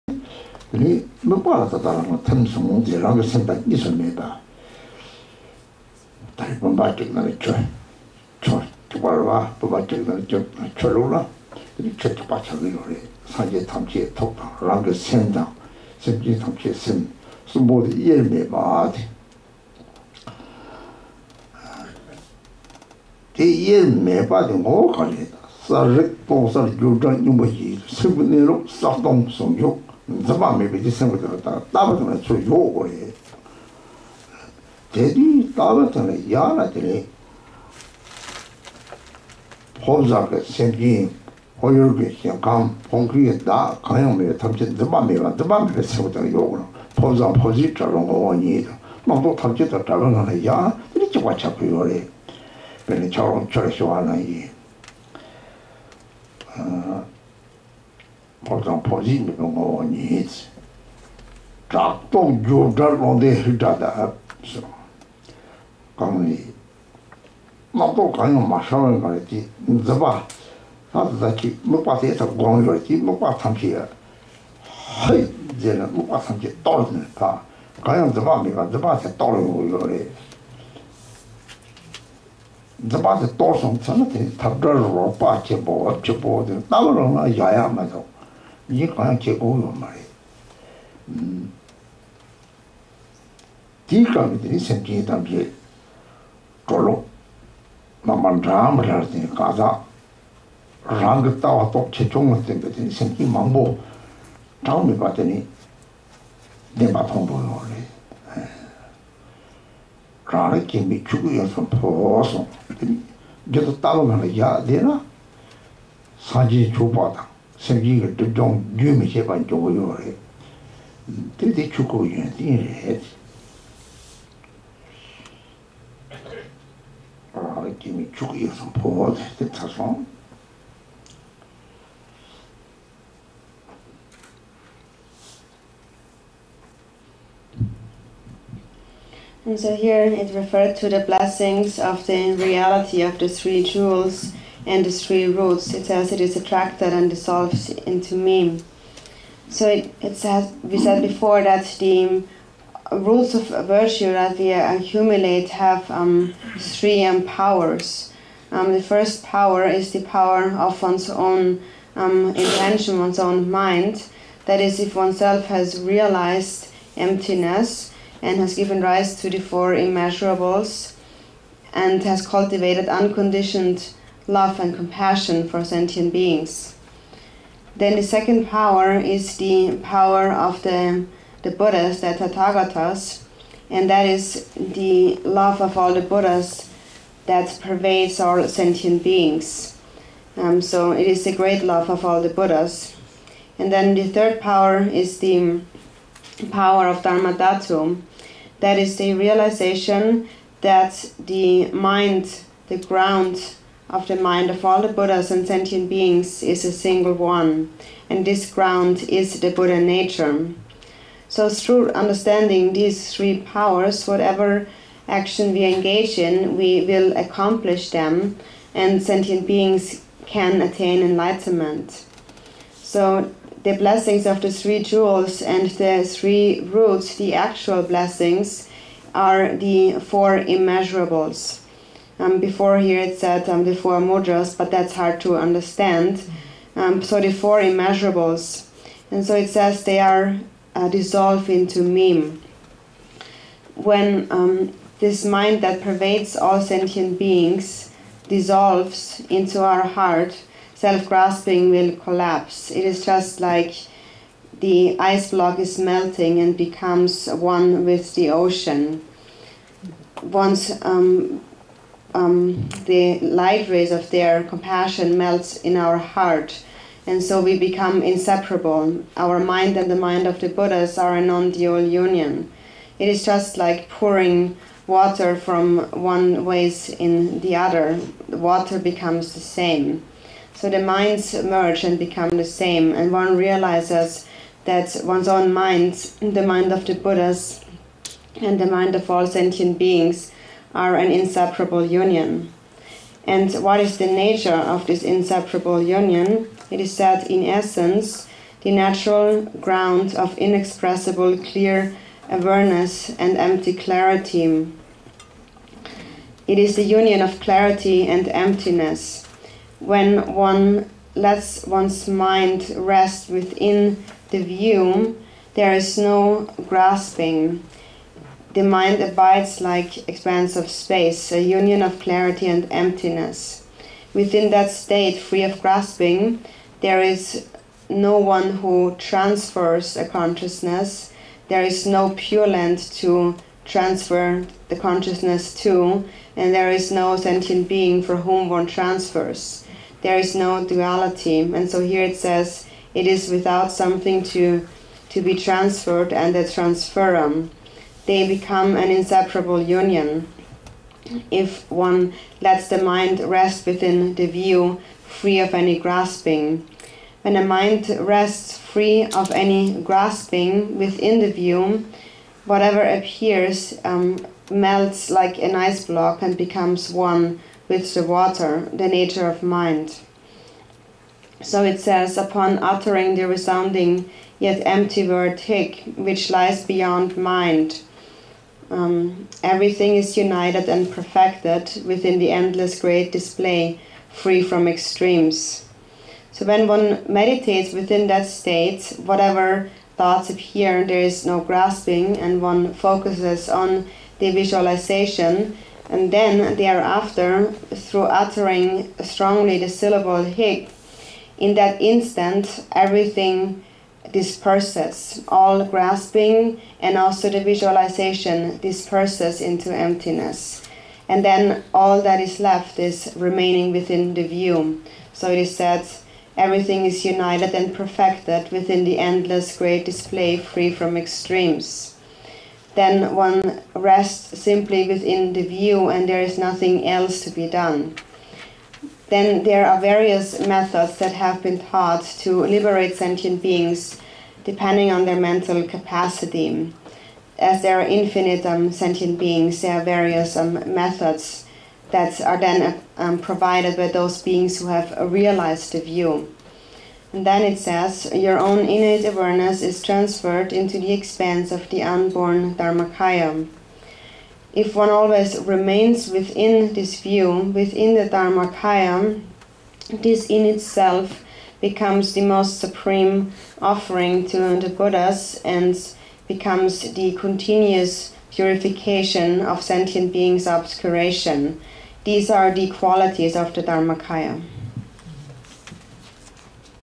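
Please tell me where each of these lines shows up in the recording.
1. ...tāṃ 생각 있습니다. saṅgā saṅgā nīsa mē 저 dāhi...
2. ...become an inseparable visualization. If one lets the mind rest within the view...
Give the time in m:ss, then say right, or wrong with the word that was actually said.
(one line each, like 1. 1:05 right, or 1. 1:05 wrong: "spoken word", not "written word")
1. 0:02 wrong: "rāngā", not "saṅgā"
2. 5:48 wrong: "union", not "visualization".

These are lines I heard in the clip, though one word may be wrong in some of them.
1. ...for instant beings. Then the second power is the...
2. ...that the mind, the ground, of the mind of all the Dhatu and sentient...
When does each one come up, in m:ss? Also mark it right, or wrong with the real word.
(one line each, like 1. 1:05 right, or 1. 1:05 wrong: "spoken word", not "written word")
1. 2:55 wrong: "sentient", not "instant"
2. 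3:20 wrong: "Buddhas", not "Dhatu".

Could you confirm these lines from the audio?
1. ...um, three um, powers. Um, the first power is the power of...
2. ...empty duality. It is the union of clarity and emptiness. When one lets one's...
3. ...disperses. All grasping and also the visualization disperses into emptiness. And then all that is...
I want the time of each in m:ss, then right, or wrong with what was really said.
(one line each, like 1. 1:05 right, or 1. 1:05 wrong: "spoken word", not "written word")
1. 2:35 right
2. 5:03 wrong: "clarity", not "duality"
3. 6:44 right.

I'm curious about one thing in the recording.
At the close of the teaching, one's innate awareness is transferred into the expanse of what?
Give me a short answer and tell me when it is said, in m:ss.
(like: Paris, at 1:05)
unborn Dharmakaya, at 7:31.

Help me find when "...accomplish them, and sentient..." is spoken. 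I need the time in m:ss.
3:37.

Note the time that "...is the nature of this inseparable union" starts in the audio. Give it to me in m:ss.
4:53.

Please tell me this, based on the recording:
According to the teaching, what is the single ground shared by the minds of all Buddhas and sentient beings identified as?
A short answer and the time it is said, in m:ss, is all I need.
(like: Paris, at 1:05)
Buddha nature, at 3:29.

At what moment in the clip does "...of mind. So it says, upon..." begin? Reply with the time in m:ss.
6:09.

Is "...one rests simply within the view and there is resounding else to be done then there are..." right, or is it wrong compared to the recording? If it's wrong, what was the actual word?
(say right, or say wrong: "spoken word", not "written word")
wrong: "nothing", not "resounding".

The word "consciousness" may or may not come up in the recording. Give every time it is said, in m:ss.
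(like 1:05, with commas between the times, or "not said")
5:30, 5:34.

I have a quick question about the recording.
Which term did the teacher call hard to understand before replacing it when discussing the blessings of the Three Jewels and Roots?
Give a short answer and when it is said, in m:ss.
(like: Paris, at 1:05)
four mudras, at 3:53.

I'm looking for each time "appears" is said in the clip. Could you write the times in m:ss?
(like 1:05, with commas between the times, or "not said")
6:02, 6:30.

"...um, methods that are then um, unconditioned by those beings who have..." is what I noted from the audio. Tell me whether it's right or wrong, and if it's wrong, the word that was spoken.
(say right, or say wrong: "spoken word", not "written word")
wrong: "provided", not "unconditioned".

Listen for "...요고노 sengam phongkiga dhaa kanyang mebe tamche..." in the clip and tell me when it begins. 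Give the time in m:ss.
0:41.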